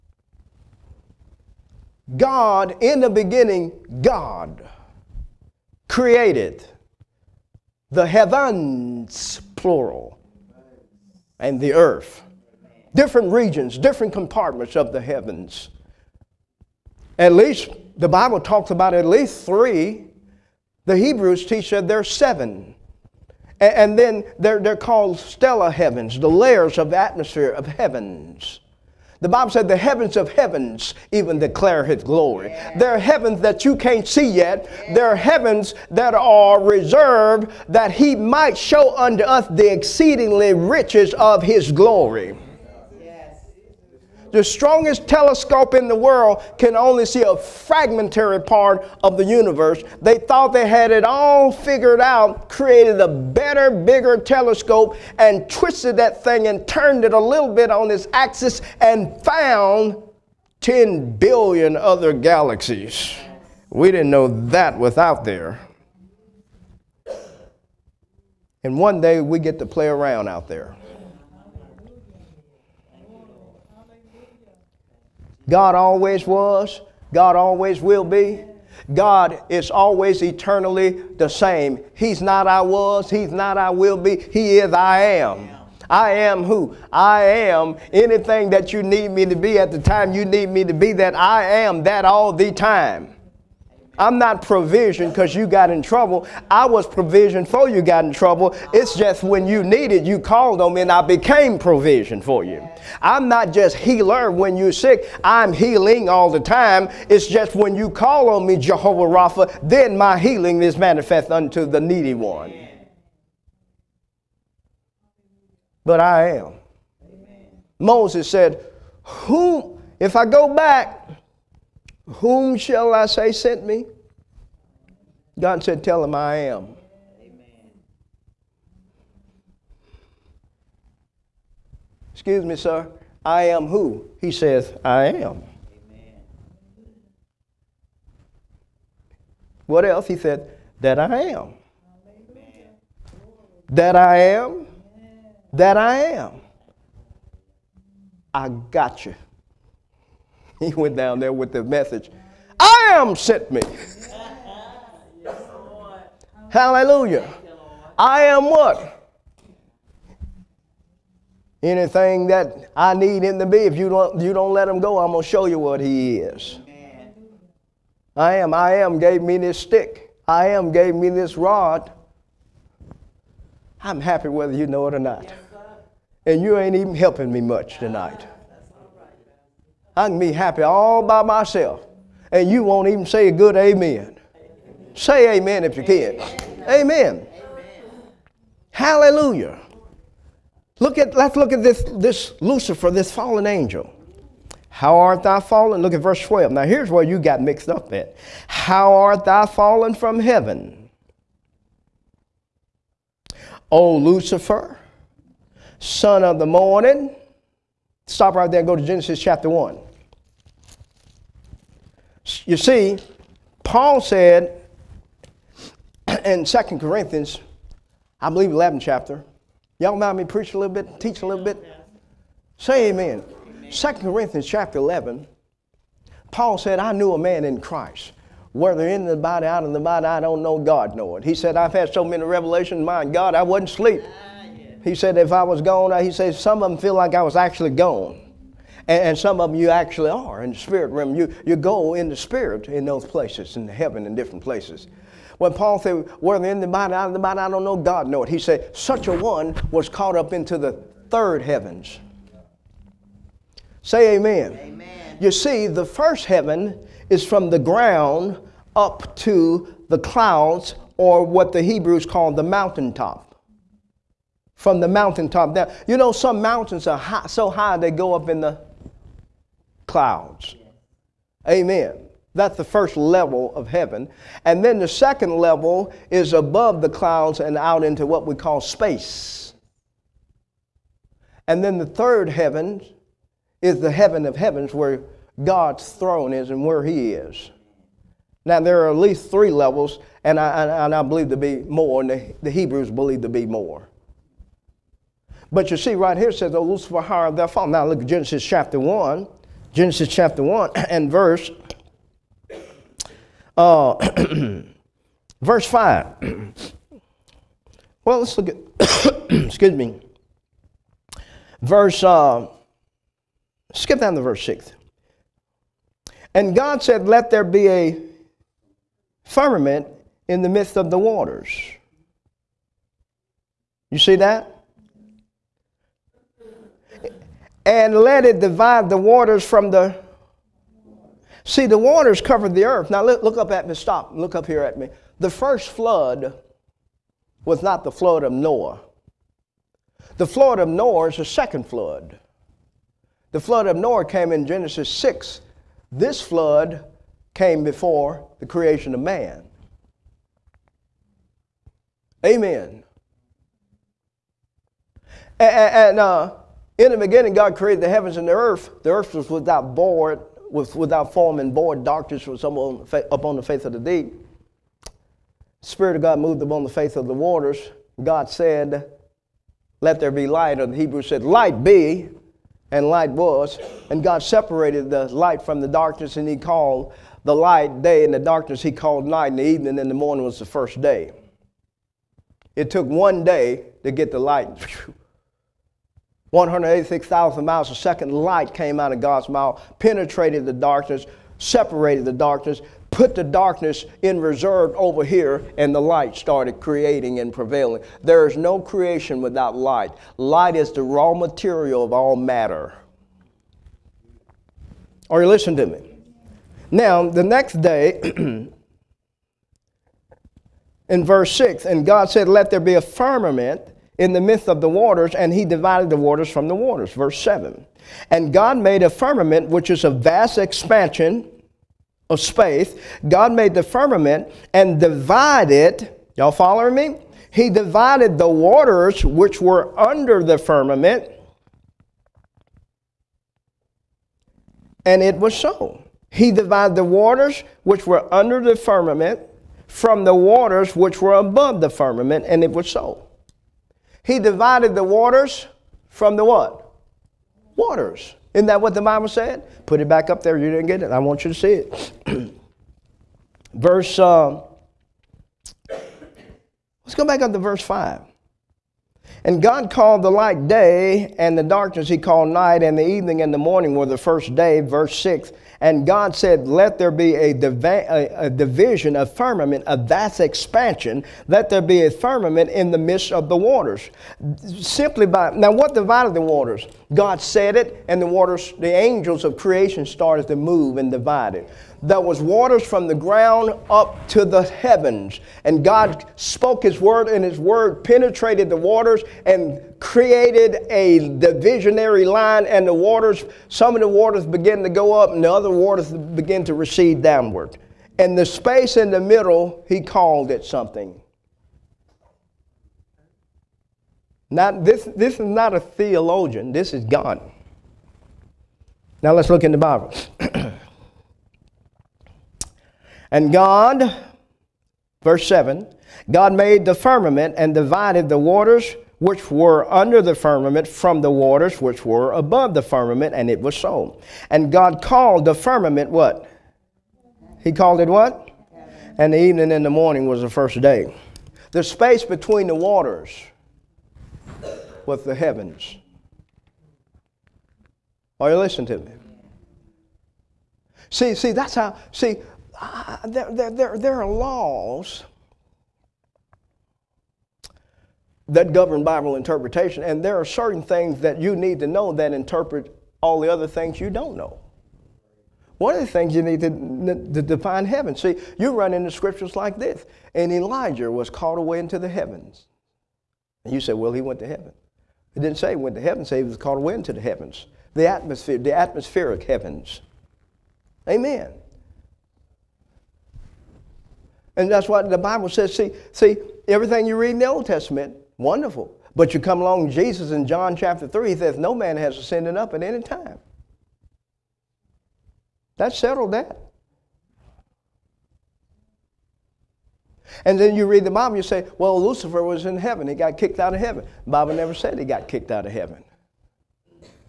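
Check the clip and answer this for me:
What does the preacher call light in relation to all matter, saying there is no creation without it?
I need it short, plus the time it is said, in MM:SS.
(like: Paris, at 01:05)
raw material, at 06:40.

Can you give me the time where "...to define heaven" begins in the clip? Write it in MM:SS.
09:16.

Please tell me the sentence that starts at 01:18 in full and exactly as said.
God is always eternally the same.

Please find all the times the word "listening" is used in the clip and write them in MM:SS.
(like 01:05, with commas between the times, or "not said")
06:45, 08:58.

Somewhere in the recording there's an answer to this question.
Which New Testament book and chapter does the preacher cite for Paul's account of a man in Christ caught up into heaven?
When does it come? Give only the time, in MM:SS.
03:43.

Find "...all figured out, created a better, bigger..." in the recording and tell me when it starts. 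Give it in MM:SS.
00:51.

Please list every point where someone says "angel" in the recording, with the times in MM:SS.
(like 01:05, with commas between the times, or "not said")
03:13, 07:58.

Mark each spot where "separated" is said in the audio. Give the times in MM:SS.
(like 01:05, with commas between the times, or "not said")
06:14, 06:31.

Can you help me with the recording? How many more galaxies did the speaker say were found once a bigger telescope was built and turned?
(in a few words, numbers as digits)
10 billion.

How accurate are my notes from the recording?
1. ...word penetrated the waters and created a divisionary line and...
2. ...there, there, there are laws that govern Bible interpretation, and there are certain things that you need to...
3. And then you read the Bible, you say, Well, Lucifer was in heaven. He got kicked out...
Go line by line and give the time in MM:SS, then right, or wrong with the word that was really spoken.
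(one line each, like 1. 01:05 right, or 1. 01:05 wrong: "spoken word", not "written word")
1. 08:07 right
2. 09:03 right
3. 09:50 right.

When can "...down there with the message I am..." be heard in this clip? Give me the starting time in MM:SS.
02:30.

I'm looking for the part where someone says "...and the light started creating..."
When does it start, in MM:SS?
06:35.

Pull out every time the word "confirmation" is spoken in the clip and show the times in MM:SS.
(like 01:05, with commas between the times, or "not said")
not said.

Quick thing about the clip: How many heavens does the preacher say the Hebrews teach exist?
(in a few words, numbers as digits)
7.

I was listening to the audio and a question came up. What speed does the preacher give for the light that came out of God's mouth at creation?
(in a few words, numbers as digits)
186,000 miles a second.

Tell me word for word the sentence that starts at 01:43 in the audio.
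I'm not just healer when you're sick.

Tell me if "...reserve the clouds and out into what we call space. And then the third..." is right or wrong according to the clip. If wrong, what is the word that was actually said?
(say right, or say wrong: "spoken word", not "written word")
wrong: "above", not "reserve".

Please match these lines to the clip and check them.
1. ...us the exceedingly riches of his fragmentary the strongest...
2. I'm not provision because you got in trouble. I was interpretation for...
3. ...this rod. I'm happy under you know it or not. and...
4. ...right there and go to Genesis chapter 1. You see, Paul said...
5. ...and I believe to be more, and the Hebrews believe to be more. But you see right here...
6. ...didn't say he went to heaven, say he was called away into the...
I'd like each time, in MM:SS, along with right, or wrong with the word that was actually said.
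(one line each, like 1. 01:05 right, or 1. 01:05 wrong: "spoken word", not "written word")
1. 00:39 wrong: "glory", not "fragmentary"
2. 01:33 wrong: "provision", not "interpretation"
3. 02:51 wrong: "whether", not "under"
4. 03:28 right
5. 04:50 right
6. 09:25 right.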